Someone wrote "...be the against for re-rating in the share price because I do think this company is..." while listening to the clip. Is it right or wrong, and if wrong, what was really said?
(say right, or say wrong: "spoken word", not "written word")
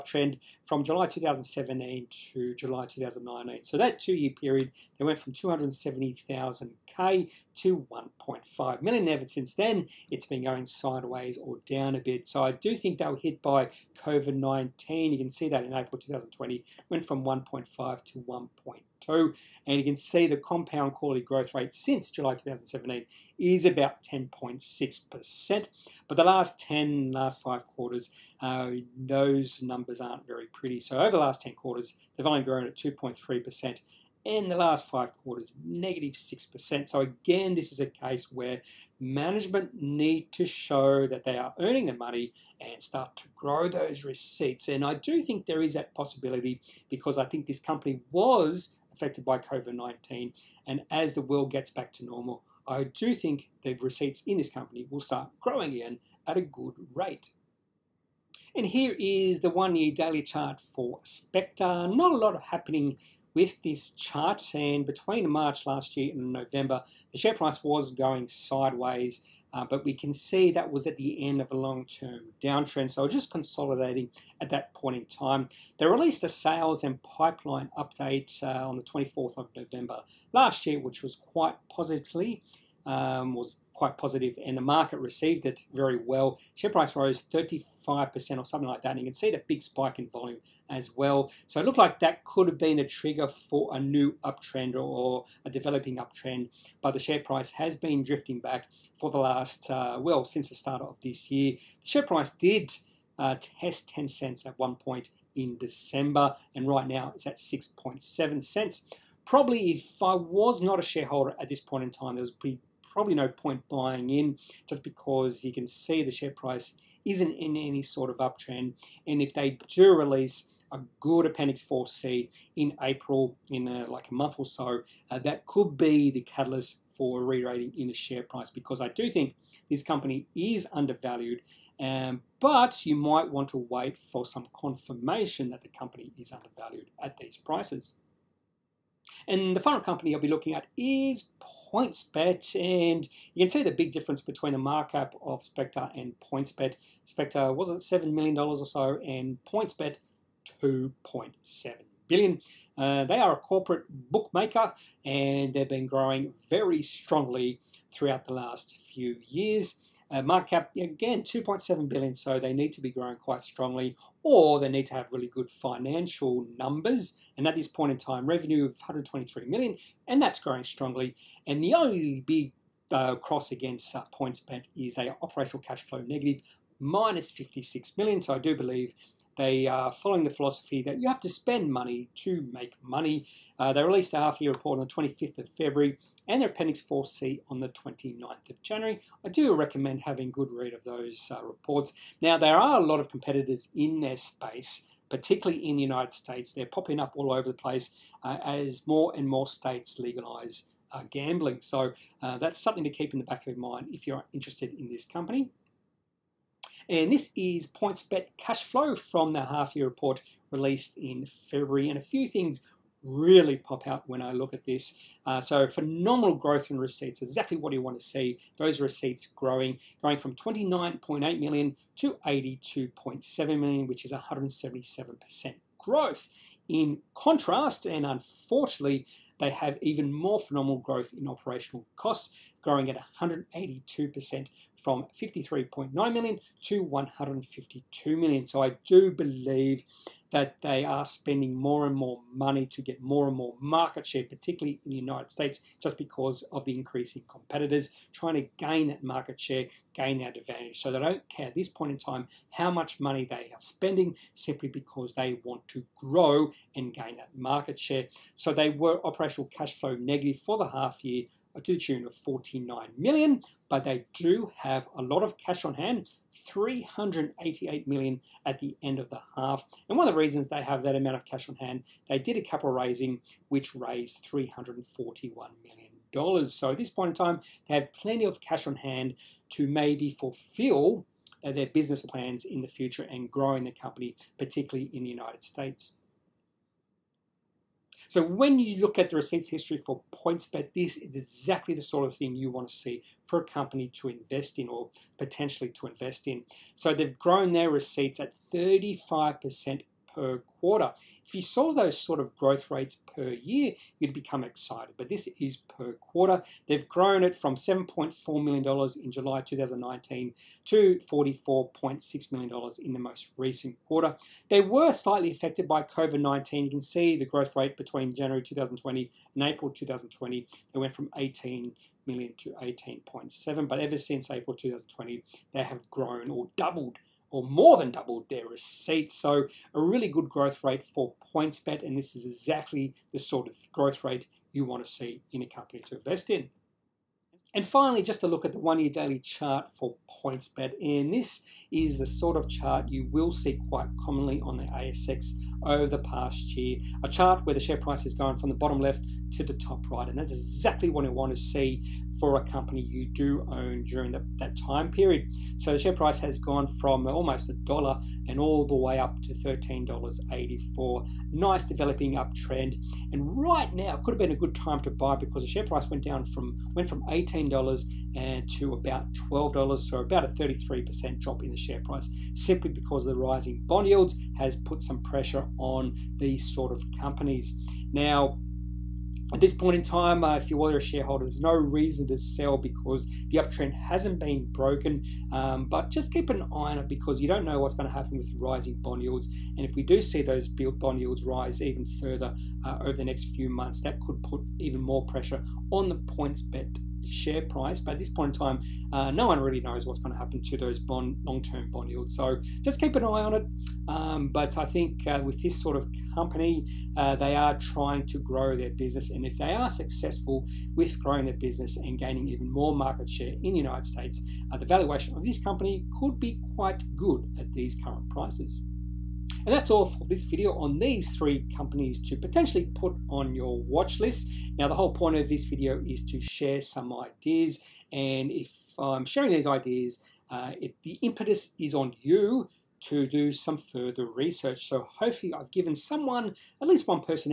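wrong: "catalyst", not "against".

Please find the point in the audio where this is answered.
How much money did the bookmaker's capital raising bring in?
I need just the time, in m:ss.
4:34.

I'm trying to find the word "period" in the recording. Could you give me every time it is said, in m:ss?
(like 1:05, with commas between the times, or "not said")
0:04, 5:54.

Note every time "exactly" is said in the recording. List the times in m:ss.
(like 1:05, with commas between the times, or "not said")
3:37, 4:51, 5:32, 5:50.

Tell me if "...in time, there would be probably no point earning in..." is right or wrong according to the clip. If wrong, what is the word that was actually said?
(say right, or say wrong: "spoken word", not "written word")
wrong: "buying", not "earning".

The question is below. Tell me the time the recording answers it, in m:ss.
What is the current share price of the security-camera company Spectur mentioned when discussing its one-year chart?
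1:47.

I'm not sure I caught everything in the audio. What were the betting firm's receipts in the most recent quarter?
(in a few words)
$44.6 million.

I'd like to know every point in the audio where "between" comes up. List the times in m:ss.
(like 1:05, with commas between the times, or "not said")
1:04, 2:24, 5:17.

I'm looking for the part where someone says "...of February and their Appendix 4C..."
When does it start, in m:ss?
3:05.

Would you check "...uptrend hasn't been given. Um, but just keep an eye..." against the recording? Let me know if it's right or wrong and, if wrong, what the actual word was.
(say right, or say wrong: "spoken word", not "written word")
wrong: "broken", not "given".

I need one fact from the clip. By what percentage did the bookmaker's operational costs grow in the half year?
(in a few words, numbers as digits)
182%.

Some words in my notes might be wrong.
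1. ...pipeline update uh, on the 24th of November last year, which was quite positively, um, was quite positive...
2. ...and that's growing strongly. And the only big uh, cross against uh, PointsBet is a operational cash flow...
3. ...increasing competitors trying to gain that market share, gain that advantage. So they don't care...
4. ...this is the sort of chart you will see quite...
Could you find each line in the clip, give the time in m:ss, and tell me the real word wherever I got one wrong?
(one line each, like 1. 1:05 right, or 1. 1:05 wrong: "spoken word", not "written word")
1. 1:17 right
2. 2:50 right
3. 4:06 right
4. 5:41 right.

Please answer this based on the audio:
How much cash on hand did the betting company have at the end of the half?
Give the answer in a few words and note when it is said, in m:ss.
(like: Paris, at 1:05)
388 million, at 4:26.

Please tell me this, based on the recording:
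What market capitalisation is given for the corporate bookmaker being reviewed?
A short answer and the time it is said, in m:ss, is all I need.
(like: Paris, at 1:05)
2.7 billion, at 2:41.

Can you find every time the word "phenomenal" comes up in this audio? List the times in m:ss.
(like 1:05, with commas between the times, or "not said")
3:35, 3:50.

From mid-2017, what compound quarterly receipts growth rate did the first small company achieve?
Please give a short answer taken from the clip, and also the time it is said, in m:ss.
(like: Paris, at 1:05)
10.6%, at 0:24.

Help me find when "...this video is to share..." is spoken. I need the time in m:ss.
7:05.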